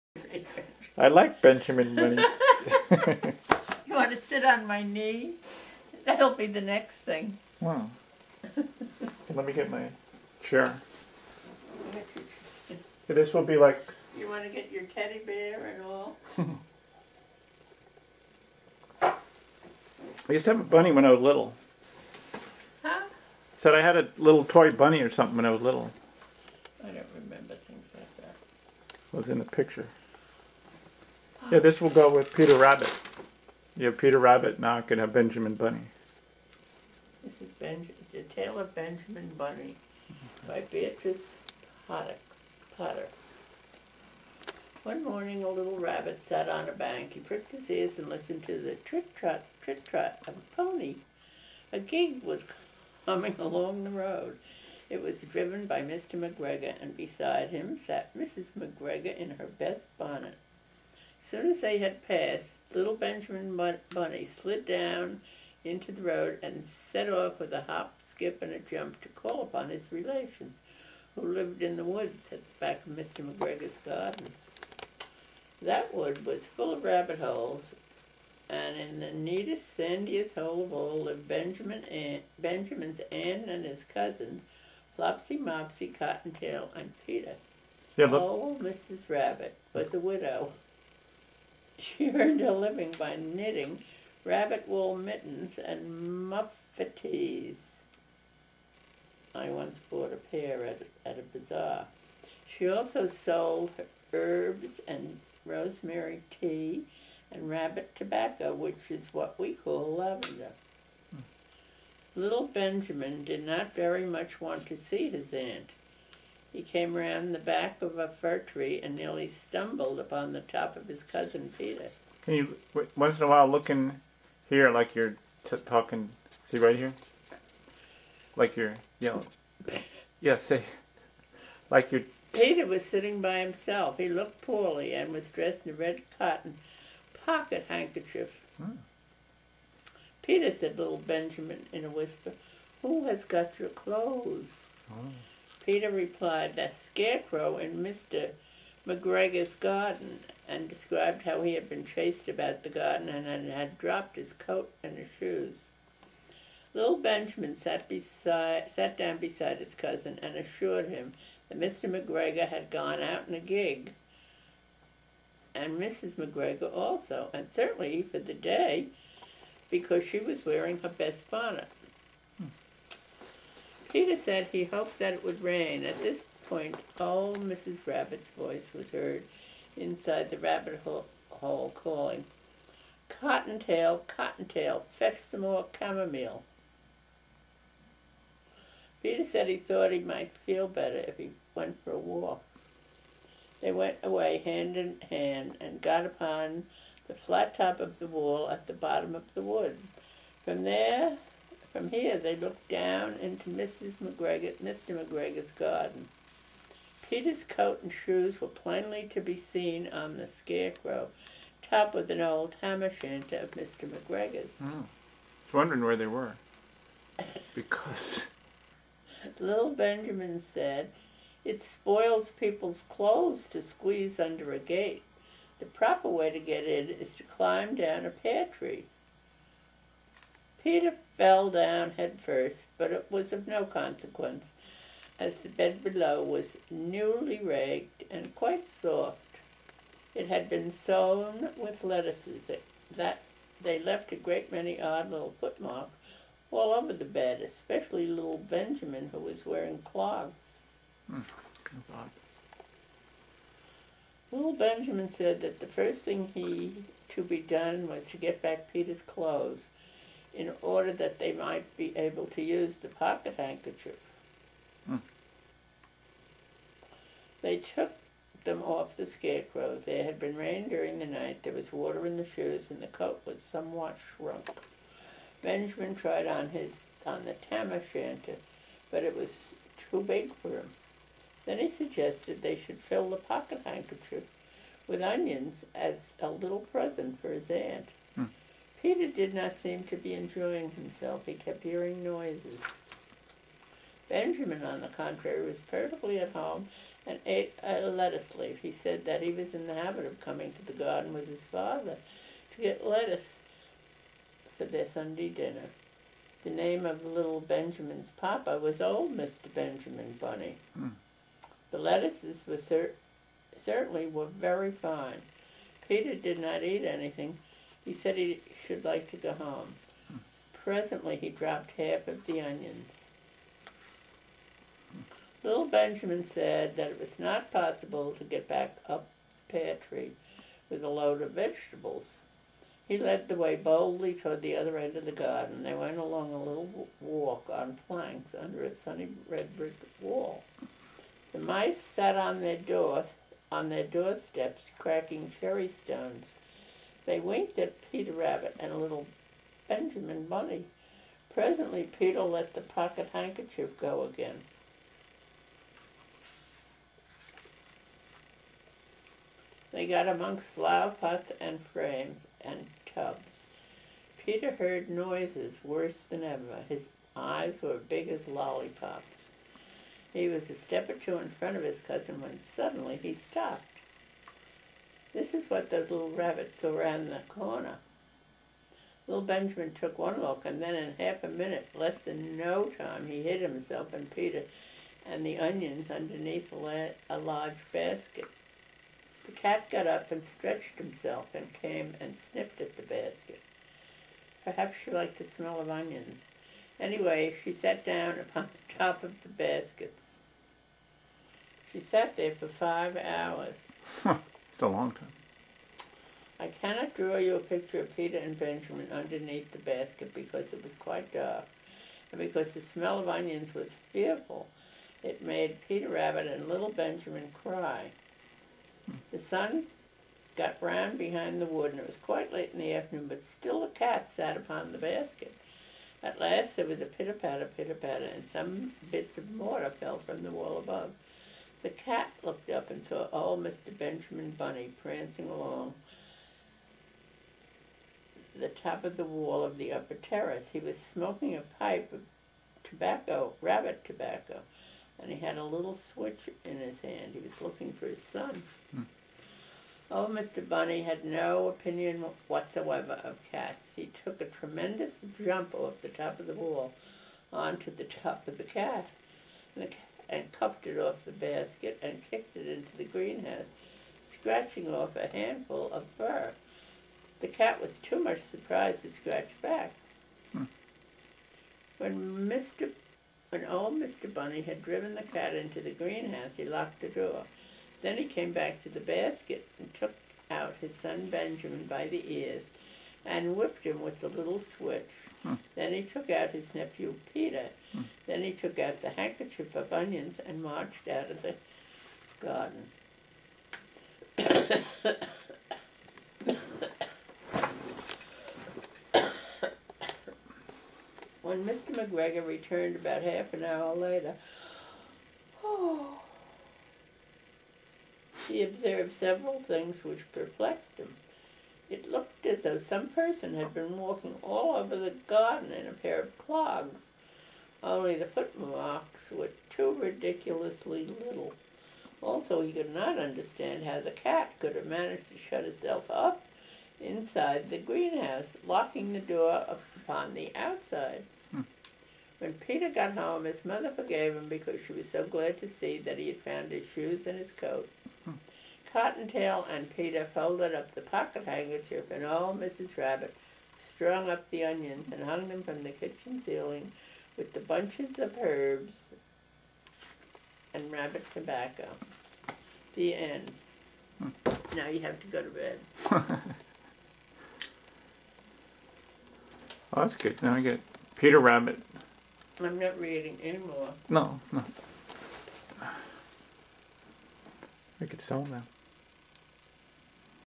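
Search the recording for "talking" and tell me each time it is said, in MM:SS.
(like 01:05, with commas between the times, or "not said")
02:05.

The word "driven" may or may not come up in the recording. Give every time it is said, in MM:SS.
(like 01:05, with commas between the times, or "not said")
00:55, 07:54.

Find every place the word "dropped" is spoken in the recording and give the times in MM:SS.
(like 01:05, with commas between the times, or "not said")
02:33, 05:21.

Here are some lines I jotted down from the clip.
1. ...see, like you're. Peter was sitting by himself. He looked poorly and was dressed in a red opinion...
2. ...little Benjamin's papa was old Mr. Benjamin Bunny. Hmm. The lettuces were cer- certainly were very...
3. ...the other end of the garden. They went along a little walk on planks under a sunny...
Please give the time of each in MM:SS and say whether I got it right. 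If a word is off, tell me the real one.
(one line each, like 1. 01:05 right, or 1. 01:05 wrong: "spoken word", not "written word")
1. 02:10 wrong: "cotton", not "opinion"
2. 05:07 right
3. 05:34 right.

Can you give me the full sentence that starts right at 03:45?
The proper way to get in is to climb down a pear tree.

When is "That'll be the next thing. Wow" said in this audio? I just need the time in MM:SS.
00:06.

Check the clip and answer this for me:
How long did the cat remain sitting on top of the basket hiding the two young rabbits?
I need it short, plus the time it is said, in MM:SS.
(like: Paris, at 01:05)
5 hours, at 06:42.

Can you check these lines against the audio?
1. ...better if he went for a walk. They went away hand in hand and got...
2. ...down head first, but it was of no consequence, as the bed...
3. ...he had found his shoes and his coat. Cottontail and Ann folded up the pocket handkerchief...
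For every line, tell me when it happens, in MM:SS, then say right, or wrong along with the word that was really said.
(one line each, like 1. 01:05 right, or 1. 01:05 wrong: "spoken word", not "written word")
1. 03:10 right
2. 03:51 right
3. 08:55 wrong: "Peter", not "Ann".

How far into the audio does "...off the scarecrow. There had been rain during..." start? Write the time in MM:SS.
04:28.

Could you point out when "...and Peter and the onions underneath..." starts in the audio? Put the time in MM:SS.
06:23.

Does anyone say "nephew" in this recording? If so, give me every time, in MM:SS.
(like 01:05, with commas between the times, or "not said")
08:06.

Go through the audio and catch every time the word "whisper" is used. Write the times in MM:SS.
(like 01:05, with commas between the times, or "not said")
02:21.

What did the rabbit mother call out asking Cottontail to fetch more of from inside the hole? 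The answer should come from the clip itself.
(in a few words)
chamomile.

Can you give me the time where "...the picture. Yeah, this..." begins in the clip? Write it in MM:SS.
00:29.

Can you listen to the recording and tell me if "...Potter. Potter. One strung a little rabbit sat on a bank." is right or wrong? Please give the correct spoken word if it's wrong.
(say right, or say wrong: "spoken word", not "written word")
wrong: "morning", not "strung".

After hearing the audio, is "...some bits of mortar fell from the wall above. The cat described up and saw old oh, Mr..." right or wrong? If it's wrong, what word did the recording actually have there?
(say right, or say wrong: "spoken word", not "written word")
wrong: "looked", not "described".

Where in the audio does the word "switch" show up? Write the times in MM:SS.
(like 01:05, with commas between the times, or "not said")
07:25, 08:04.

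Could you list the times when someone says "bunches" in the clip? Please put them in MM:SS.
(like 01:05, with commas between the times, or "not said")
09:07.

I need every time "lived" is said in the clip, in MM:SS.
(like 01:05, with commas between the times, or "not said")
01:11, 01:21.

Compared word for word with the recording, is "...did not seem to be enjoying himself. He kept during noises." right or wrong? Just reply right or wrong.
wrong.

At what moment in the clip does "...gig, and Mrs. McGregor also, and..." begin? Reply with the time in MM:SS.
02:43.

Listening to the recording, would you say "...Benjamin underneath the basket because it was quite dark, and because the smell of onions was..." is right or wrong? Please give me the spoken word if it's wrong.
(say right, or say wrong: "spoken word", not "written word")
right.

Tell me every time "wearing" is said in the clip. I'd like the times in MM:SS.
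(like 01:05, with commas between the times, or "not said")
02:50, 04:09.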